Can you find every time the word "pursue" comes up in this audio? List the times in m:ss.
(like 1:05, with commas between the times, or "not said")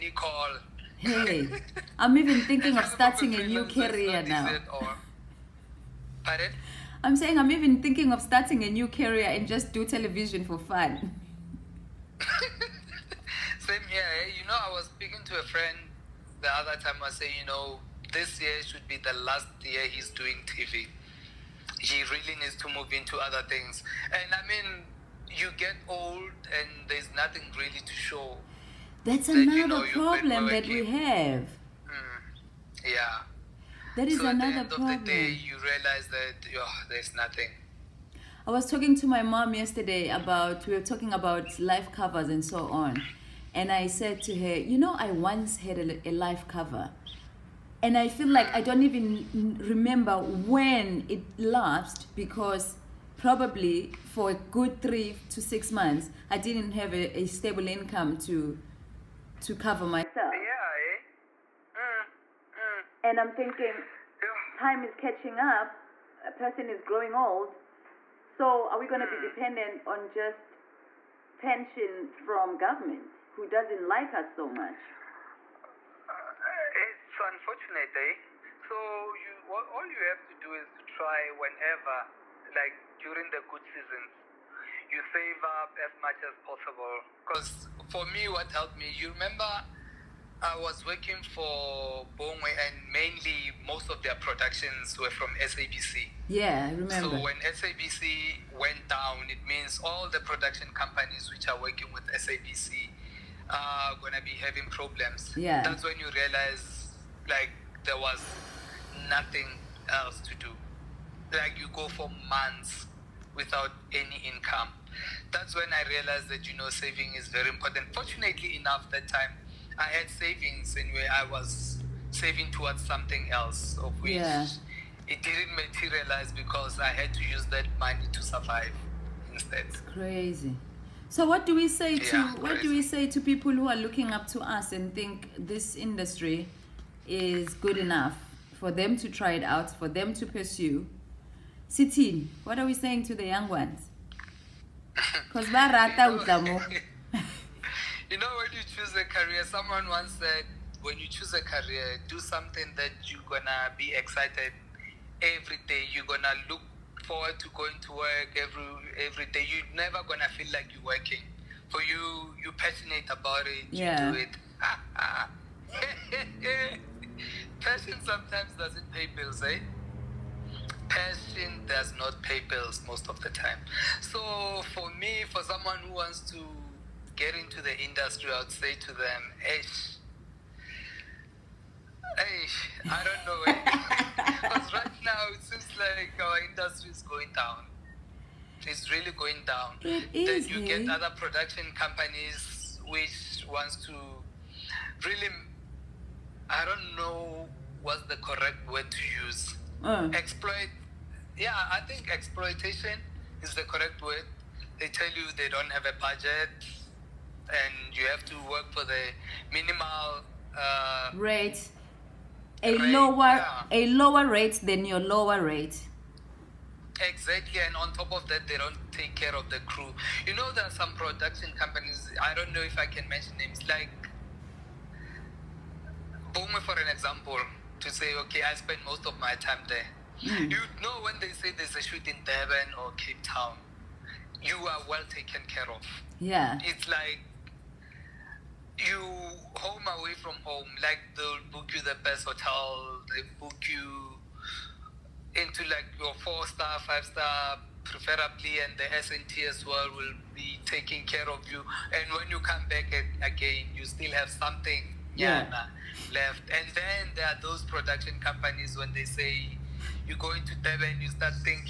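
2:20.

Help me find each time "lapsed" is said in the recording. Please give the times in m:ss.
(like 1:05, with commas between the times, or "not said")
0:51.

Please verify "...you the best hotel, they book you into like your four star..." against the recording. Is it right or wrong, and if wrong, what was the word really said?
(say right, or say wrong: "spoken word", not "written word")
right.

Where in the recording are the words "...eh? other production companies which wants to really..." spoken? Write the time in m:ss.
3:10.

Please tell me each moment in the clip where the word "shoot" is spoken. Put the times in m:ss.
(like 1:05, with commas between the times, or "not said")
3:51.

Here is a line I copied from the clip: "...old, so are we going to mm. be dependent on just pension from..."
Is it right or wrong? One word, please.
right.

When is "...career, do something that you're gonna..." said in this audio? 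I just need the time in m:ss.
2:31.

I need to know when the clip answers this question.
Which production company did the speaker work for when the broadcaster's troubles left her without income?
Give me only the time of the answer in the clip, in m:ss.
1:32.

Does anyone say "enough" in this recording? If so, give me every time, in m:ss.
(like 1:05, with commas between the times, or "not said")
1:58, 2:17.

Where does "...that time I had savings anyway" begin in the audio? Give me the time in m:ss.
1:58.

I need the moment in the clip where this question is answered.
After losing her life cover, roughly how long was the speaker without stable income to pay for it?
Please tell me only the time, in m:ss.
0:54.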